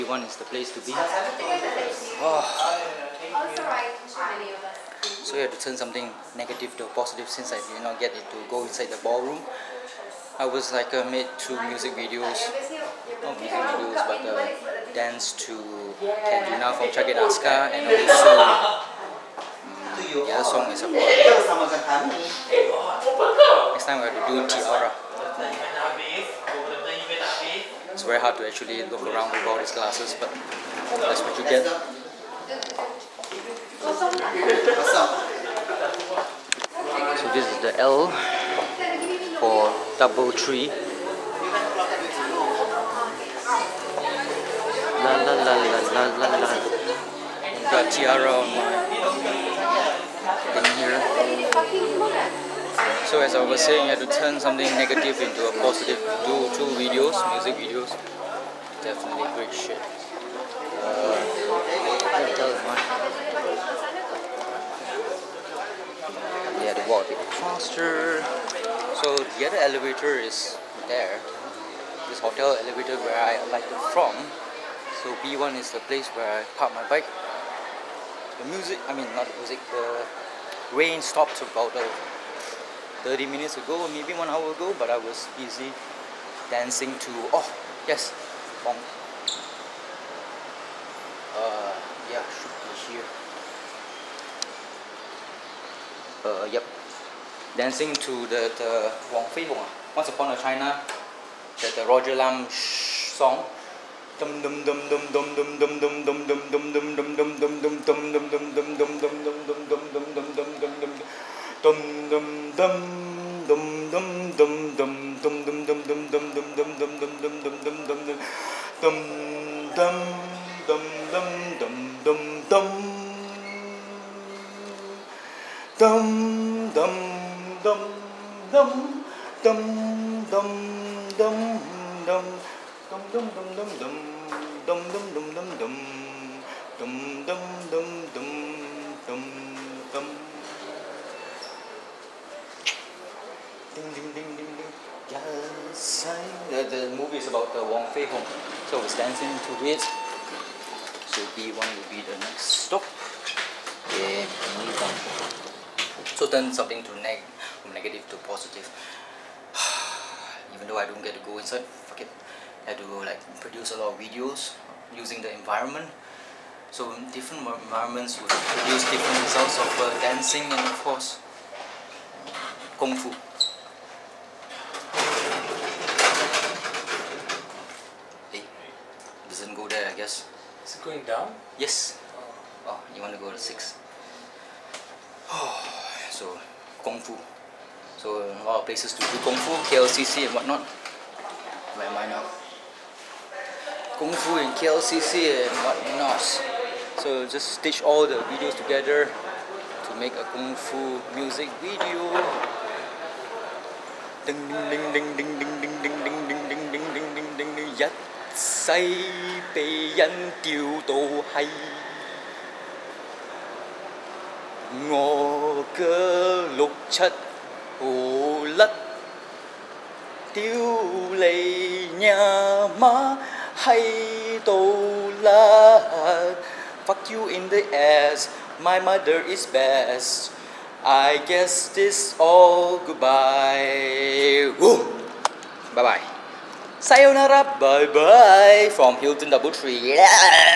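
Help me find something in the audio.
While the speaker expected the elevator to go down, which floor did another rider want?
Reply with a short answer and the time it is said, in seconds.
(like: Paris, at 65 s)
6, at 183 s.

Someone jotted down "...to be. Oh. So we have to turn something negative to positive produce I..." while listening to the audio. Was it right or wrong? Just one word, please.
wrong.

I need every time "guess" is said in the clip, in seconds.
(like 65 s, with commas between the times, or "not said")
179 s, 231 s.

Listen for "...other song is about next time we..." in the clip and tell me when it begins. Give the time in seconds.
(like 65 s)
20 s.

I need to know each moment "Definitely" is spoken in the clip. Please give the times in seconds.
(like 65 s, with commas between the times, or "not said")
58 s.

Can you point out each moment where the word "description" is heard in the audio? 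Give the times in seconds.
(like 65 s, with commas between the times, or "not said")
not said.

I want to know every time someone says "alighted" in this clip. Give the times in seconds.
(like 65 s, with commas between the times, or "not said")
73 s.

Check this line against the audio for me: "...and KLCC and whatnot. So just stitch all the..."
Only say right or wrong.
right.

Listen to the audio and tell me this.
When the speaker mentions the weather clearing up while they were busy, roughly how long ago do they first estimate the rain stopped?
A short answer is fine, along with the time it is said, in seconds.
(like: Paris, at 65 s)
30 minutes, at 83 s.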